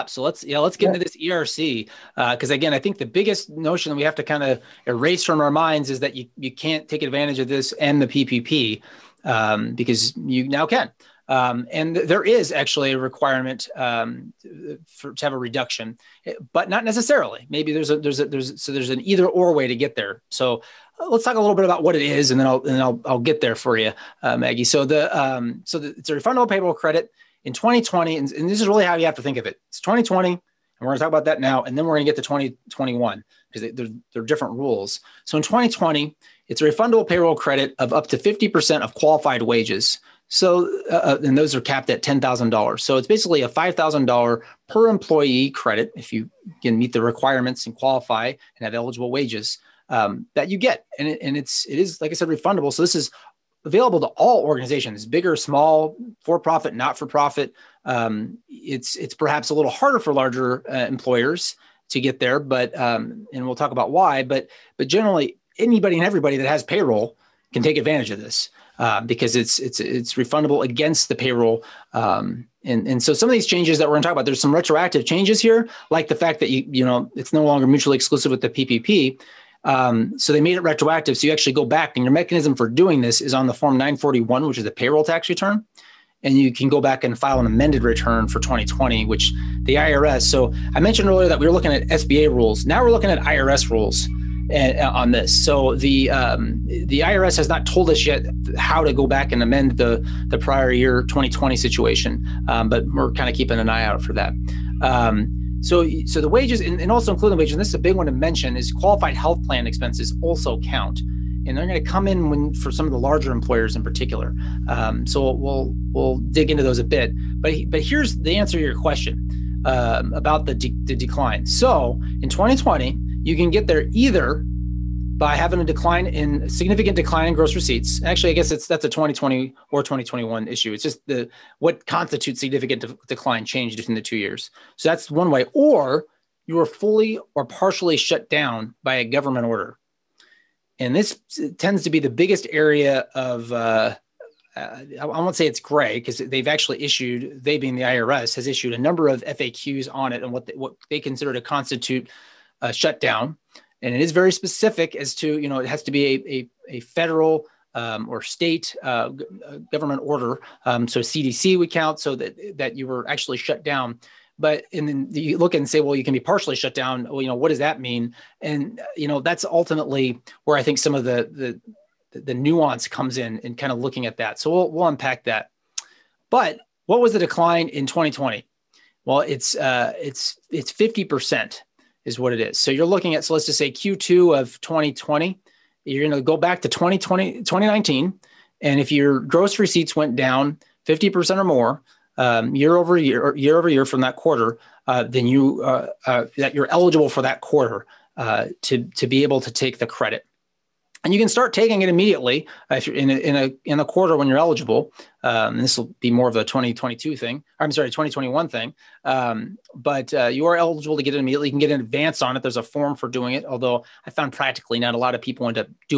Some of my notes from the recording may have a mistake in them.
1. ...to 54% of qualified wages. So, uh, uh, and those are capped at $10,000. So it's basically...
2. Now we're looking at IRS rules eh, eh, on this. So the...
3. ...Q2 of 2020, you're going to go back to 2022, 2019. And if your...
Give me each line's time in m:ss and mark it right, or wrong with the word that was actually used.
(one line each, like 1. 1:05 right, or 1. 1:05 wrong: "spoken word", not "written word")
1. 0:38 wrong: "50", not "54"
2. 1:32 right
3. 3:03 wrong: "2020", not "2022".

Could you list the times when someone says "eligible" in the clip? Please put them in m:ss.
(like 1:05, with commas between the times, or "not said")
0:48, 3:16, 3:24, 3:30.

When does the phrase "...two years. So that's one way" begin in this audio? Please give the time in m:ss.
2:14.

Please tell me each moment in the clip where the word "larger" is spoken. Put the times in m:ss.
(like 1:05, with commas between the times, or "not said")
1:00, 1:52.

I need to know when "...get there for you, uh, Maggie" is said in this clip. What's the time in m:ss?
0:23.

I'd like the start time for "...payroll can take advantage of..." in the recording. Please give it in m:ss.
1:06.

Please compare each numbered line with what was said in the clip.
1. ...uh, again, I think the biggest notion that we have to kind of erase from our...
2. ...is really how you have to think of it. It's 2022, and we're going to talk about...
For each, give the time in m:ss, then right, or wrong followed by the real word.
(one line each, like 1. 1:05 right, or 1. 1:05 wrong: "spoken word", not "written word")
1. 0:02 right
2. 0:28 wrong: "2020", not "2022".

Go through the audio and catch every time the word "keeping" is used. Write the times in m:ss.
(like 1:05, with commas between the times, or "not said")
1:43.